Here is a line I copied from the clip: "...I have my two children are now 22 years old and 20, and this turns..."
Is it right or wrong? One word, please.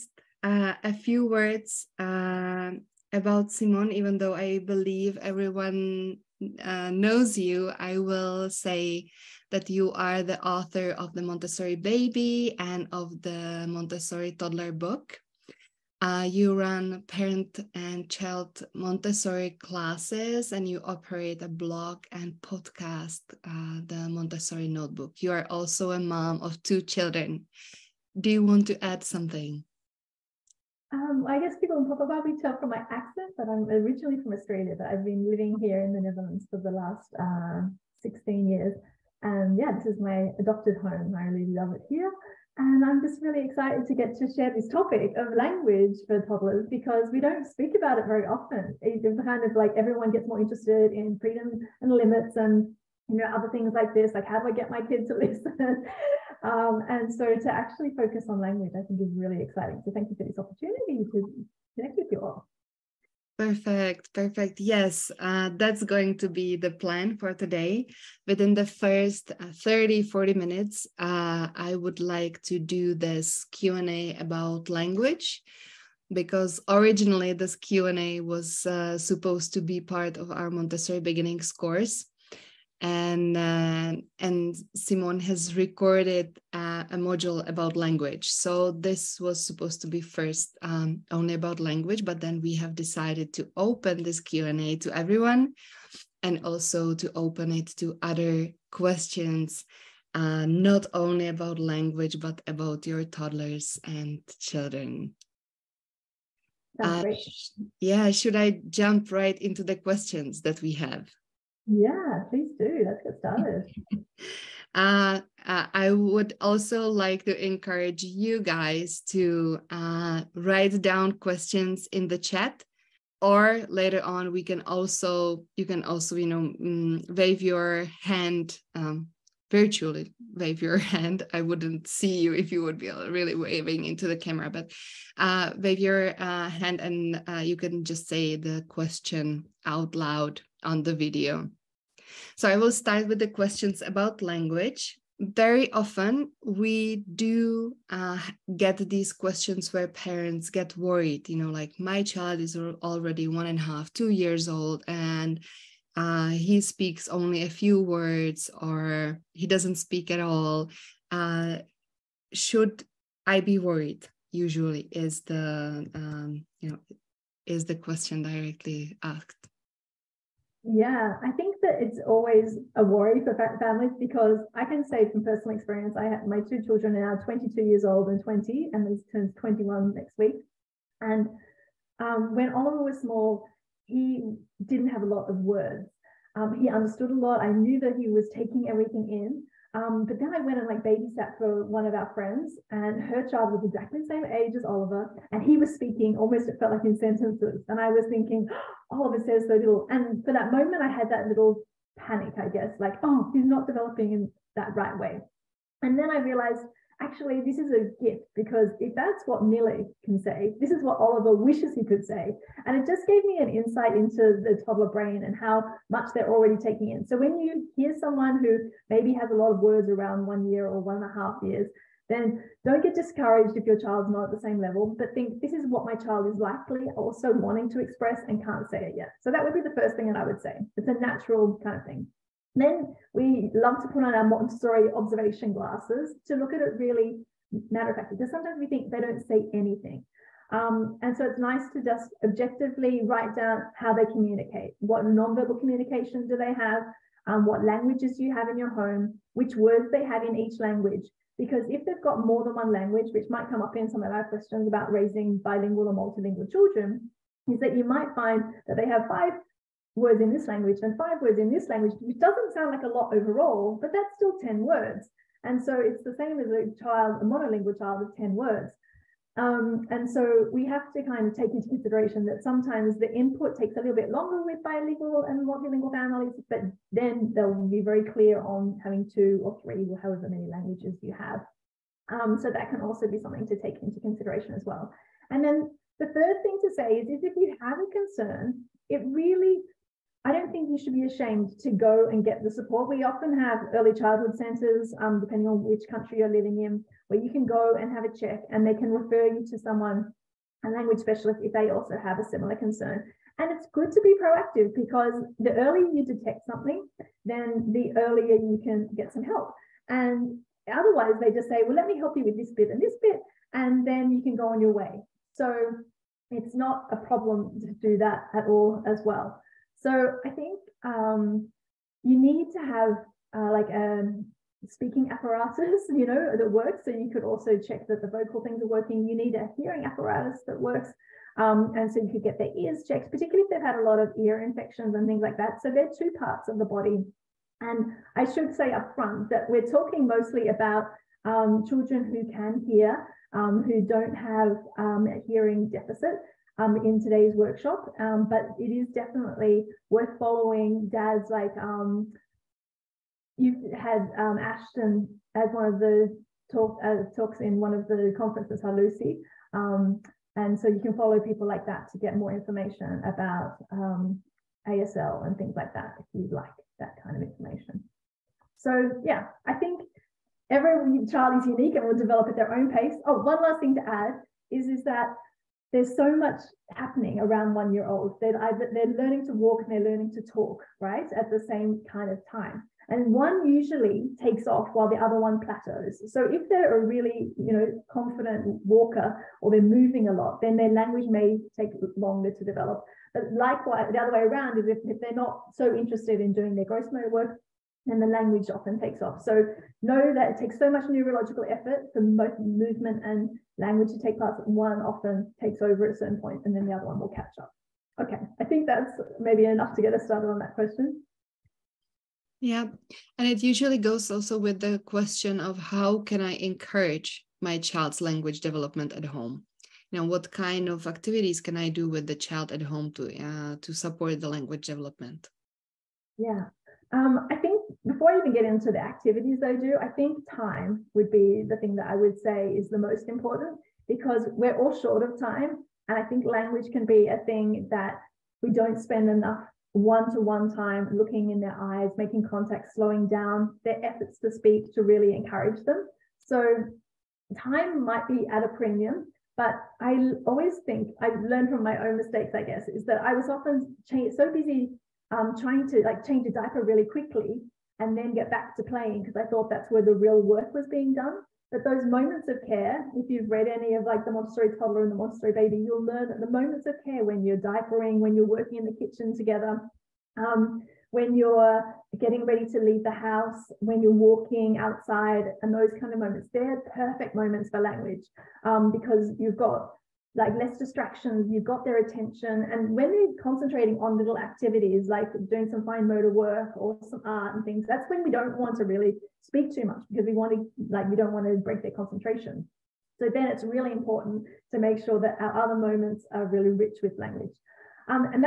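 right.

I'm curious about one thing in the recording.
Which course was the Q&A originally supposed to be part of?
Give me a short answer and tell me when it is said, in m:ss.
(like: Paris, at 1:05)
Montessori Beginnings, at 1:20.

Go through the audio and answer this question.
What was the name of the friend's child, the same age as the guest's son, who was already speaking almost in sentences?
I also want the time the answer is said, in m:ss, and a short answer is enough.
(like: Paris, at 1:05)
Millie, at 3:29.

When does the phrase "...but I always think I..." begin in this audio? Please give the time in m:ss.
7:29.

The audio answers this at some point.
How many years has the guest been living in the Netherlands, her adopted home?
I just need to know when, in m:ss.
0:38.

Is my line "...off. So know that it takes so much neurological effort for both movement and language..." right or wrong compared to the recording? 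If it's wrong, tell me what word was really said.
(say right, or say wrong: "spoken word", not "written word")
right.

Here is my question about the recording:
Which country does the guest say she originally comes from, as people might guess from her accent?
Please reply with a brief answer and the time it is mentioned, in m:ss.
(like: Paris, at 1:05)
Australia, at 0:34.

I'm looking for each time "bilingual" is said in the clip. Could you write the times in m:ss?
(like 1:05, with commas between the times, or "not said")
4:15, 4:34.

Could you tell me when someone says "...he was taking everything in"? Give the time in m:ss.
3:07.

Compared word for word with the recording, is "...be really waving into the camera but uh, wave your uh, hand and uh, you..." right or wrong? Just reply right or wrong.
right.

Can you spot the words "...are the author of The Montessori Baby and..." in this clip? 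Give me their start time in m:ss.
0:09.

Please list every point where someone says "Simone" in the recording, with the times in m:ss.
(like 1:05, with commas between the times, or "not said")
0:03, 1:24.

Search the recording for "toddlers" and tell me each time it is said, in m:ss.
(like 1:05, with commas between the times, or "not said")
0:14, 0:46, 1:43, 3:34, 7:44.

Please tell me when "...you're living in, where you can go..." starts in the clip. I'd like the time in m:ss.
4:56.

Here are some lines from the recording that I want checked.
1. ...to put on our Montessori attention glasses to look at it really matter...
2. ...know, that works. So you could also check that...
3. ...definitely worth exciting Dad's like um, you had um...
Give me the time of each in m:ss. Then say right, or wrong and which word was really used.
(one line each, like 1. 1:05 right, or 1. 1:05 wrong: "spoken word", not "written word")
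1. 3:53 wrong: "observation", not "attention"
2. 5:26 right
3. 5:48 wrong: "following", not "exciting".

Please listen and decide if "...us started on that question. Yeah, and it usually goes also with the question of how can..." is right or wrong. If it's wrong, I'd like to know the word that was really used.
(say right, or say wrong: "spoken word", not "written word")
right.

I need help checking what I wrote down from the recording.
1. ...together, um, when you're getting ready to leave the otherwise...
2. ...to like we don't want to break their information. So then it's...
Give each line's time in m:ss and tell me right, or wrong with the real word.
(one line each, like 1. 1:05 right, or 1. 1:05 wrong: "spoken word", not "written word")
1. 7:49 wrong: "house", not "otherwise"
2. 8:10 wrong: "concentration", not "information".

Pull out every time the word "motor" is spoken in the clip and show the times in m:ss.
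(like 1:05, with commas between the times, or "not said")
6:36, 8:05.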